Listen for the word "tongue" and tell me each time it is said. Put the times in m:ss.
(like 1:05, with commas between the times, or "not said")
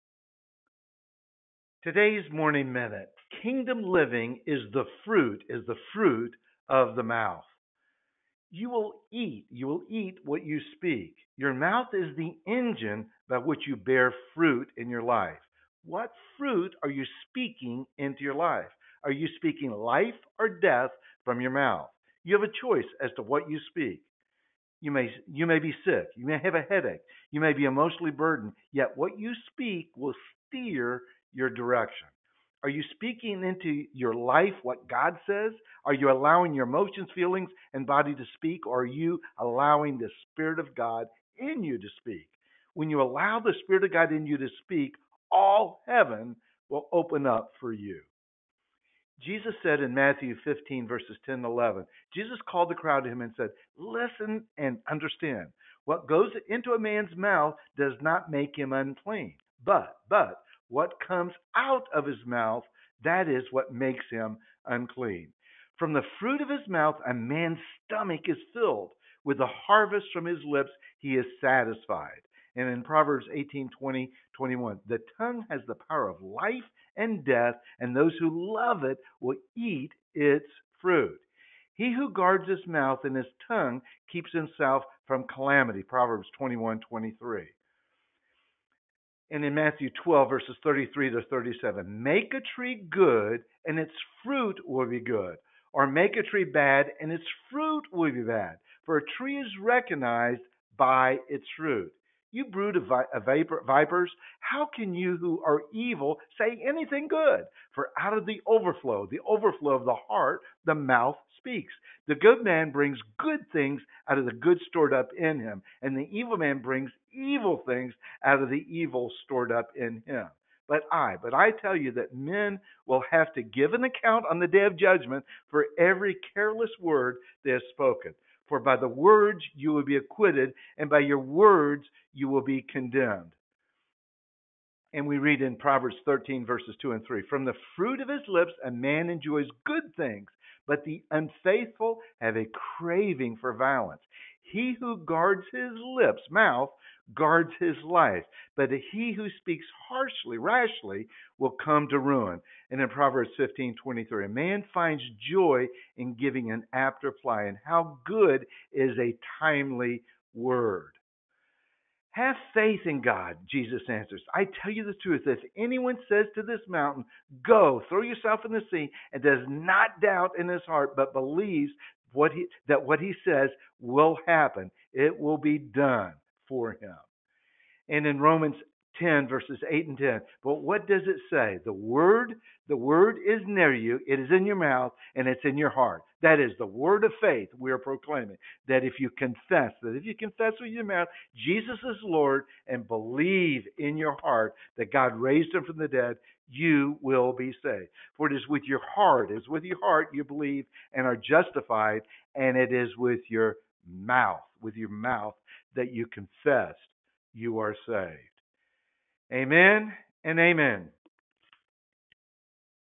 1:15, 1:23.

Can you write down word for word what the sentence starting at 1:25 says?
Proverbs 21 23 and in Matthew 12, verses 33 to 37.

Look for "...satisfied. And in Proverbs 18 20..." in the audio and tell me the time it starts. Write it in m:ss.
1:11.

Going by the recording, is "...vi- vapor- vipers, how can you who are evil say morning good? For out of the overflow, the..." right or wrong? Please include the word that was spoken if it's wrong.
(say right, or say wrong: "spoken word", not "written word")
wrong: "anything", not "morning".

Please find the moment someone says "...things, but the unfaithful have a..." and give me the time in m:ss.
2:19.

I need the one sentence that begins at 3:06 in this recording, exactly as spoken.
That is the word of faith we are proclaiming.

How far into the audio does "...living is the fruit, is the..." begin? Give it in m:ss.
0:03.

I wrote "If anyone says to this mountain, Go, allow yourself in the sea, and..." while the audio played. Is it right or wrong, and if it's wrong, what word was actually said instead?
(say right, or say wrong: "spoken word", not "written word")
wrong: "throw", not "allow".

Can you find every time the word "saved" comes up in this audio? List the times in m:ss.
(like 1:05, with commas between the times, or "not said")
3:17, 3:27.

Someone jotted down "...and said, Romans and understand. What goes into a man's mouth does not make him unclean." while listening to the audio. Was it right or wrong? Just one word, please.
wrong.